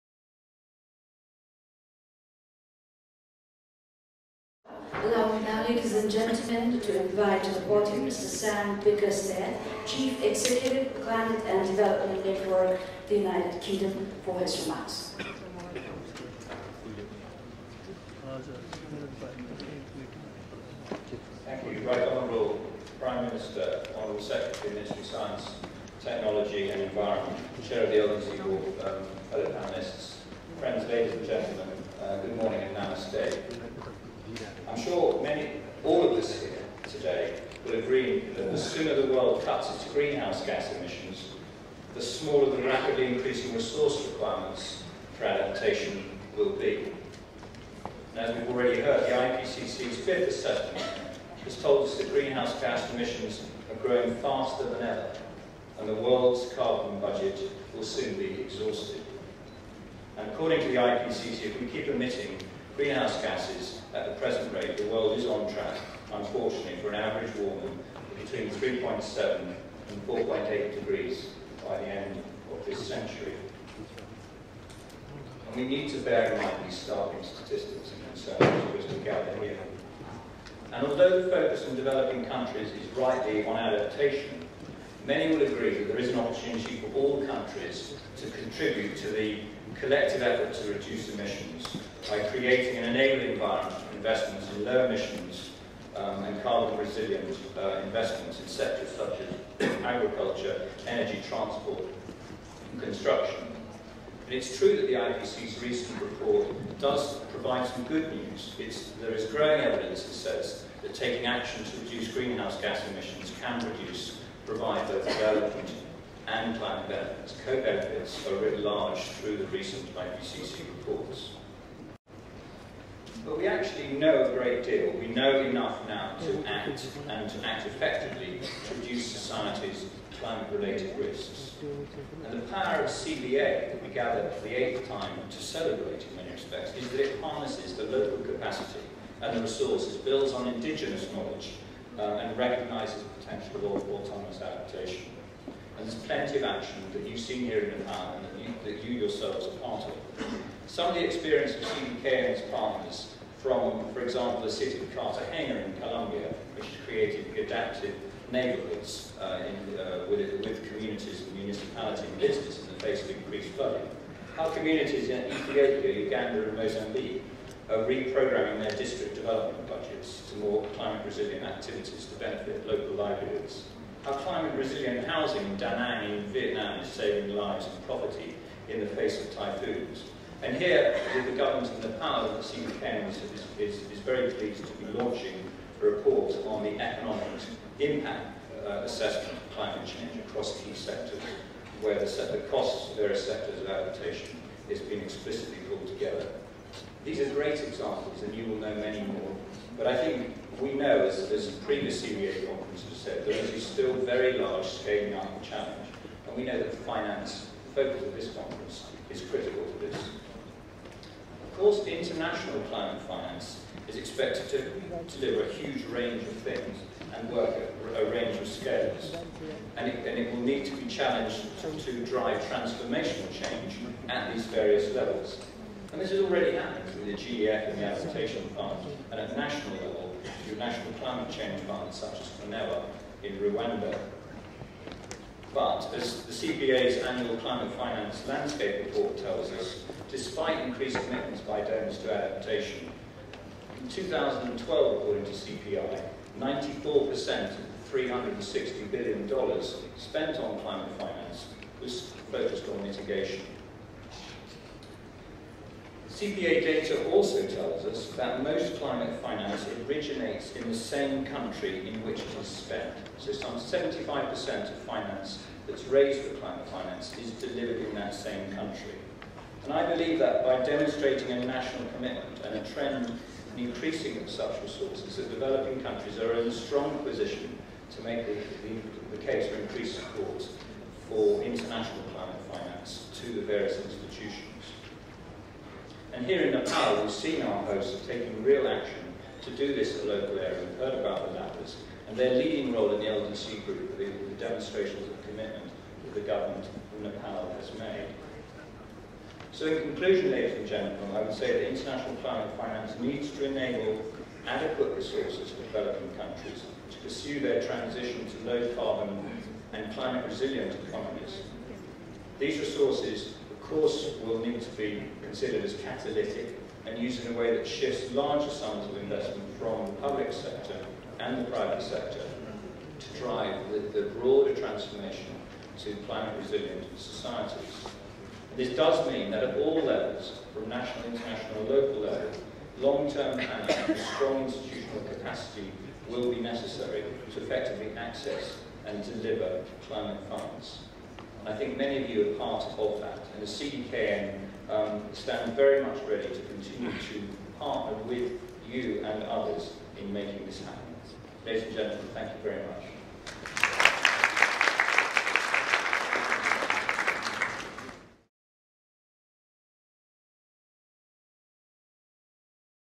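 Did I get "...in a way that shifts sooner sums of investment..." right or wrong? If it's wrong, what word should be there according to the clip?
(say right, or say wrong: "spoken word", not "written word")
wrong: "larger", not "sooner".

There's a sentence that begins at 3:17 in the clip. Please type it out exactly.
These are great examples, and you will know many more.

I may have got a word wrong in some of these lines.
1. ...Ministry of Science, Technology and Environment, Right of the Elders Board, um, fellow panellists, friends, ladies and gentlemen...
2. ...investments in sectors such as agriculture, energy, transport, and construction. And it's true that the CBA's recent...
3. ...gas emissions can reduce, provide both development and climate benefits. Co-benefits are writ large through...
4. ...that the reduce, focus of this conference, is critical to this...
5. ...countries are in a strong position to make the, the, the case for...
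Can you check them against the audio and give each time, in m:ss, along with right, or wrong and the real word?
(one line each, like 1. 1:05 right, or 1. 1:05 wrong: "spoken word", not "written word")
1. 0:24 wrong: "Chair", not "Right"
2. 1:37 wrong: "IPCC", not "CBA"
3. 1:52 right
4. 3:26 wrong: "finance", not "reduce"
5. 4:35 right.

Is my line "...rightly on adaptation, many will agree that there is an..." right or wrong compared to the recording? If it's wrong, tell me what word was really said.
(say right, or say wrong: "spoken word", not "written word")
right.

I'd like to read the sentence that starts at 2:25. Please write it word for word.
And there's plenty of action that you've seen here in Nepal and that you, that you yourselves are part of.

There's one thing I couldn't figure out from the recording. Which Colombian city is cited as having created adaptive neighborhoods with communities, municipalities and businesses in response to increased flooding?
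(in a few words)
Cartagena.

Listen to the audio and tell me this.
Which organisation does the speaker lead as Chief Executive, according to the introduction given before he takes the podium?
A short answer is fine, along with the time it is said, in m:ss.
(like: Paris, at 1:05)
Climate and Development Network, at 0:11.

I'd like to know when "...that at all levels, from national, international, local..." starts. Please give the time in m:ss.
5:29.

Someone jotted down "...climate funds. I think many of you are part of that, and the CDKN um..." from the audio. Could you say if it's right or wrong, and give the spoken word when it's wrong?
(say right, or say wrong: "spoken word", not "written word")
right.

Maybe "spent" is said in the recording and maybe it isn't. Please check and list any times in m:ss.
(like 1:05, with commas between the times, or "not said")
4:09, 4:22.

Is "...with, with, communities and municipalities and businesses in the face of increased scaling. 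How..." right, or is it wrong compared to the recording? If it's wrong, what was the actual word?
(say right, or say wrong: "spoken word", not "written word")
wrong: "flooding", not "scaling".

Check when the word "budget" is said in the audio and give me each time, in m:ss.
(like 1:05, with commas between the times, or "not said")
0:56, 2:49.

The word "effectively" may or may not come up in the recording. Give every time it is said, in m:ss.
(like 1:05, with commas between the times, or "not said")
2:07, 5:37.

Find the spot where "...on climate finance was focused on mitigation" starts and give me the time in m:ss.
4:10.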